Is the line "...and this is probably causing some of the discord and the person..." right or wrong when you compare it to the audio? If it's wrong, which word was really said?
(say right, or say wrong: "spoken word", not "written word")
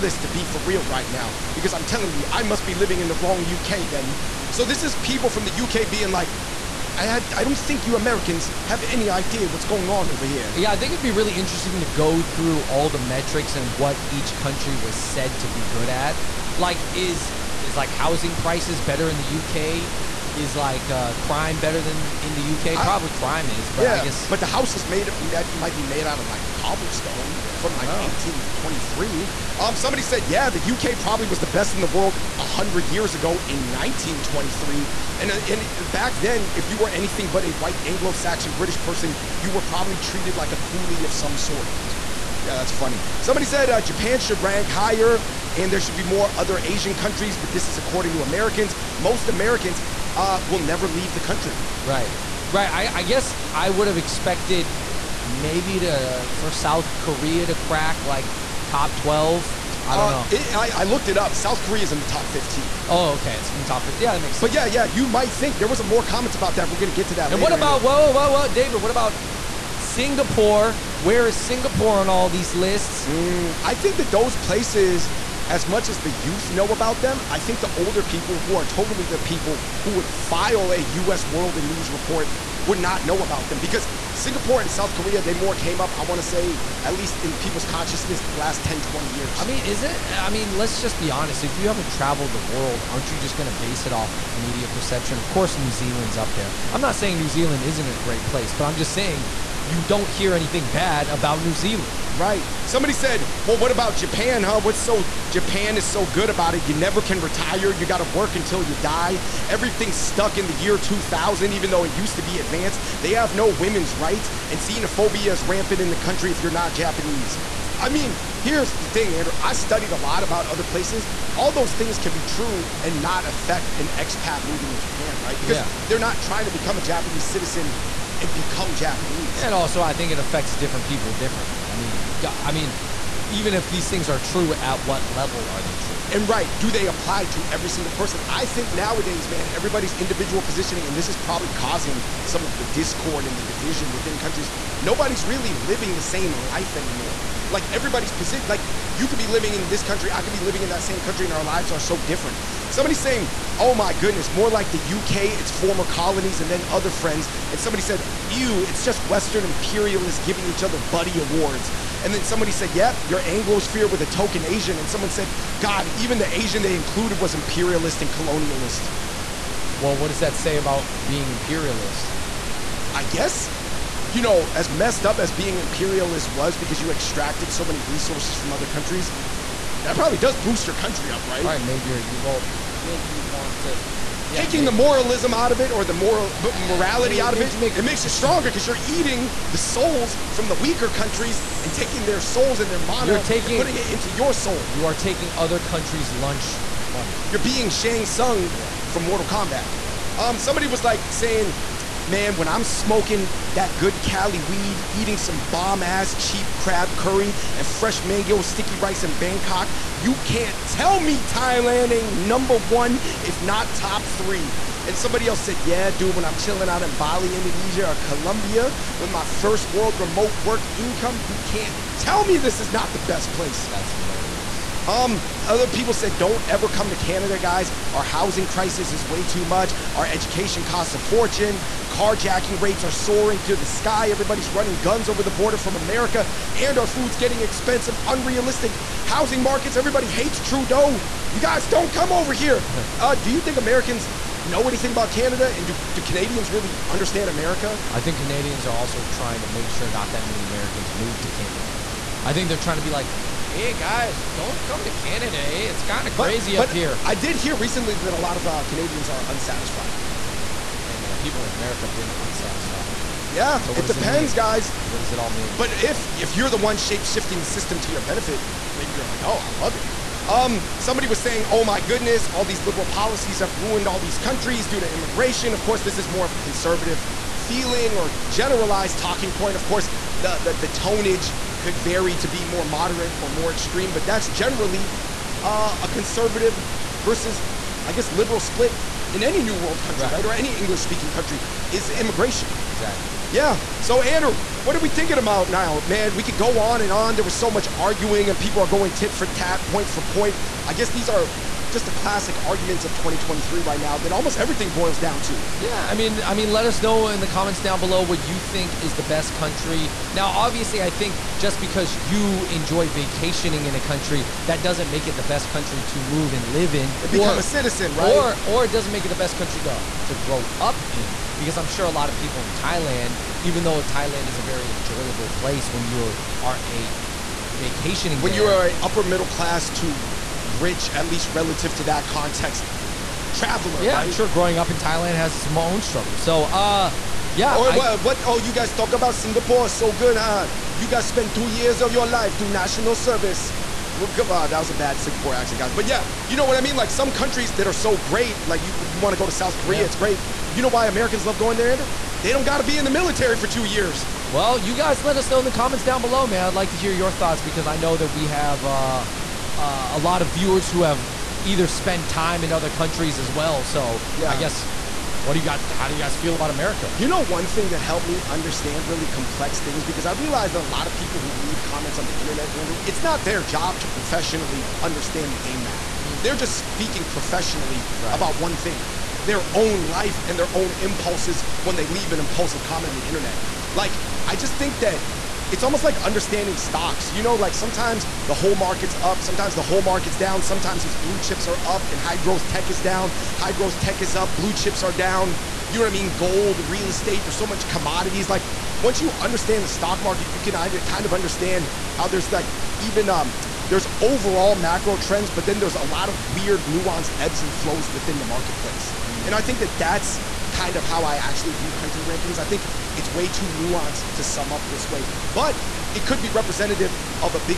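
wrong: "division", not "person".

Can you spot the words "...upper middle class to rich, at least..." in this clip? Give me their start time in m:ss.
5:28.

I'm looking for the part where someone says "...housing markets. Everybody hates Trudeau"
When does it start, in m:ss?
3:59.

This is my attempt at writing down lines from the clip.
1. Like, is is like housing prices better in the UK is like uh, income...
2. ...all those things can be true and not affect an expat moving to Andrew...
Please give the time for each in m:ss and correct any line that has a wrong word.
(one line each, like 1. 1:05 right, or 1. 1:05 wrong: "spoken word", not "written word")
1. 0:16 wrong: "crime", not "income"
2. 2:01 wrong: "Japan", not "Andrew".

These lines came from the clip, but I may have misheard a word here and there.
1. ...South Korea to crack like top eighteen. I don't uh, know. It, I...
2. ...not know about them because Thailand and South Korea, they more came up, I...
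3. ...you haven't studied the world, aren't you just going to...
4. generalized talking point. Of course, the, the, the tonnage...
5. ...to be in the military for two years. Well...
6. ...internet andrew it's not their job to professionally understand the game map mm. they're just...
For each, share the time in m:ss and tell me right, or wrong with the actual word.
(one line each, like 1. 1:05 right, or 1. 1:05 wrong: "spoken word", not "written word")
1. 0:56 wrong: "twelve", not "eighteen"
2. 1:22 wrong: "Singapore", not "Thailand"
3. 1:31 wrong: "traveled", not "studied"
4. 4:38 right
5. 5:52 right
6. 6:12 right.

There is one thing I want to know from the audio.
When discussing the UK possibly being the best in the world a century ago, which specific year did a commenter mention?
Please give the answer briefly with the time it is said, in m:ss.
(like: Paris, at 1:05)
1923, at 0:33.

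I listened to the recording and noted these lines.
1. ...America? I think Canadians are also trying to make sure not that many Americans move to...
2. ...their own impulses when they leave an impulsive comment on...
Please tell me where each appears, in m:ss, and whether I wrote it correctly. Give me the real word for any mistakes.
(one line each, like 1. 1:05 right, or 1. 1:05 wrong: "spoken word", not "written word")
1. 4:07 right
2. 6:20 right.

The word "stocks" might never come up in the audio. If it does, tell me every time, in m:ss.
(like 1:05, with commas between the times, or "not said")
6:26, 6:39.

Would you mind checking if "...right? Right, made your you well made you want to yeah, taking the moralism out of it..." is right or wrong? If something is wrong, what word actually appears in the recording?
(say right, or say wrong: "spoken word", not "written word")
right.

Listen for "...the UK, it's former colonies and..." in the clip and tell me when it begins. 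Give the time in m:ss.
2:34.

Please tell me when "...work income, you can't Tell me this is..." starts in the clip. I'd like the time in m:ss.
3:40.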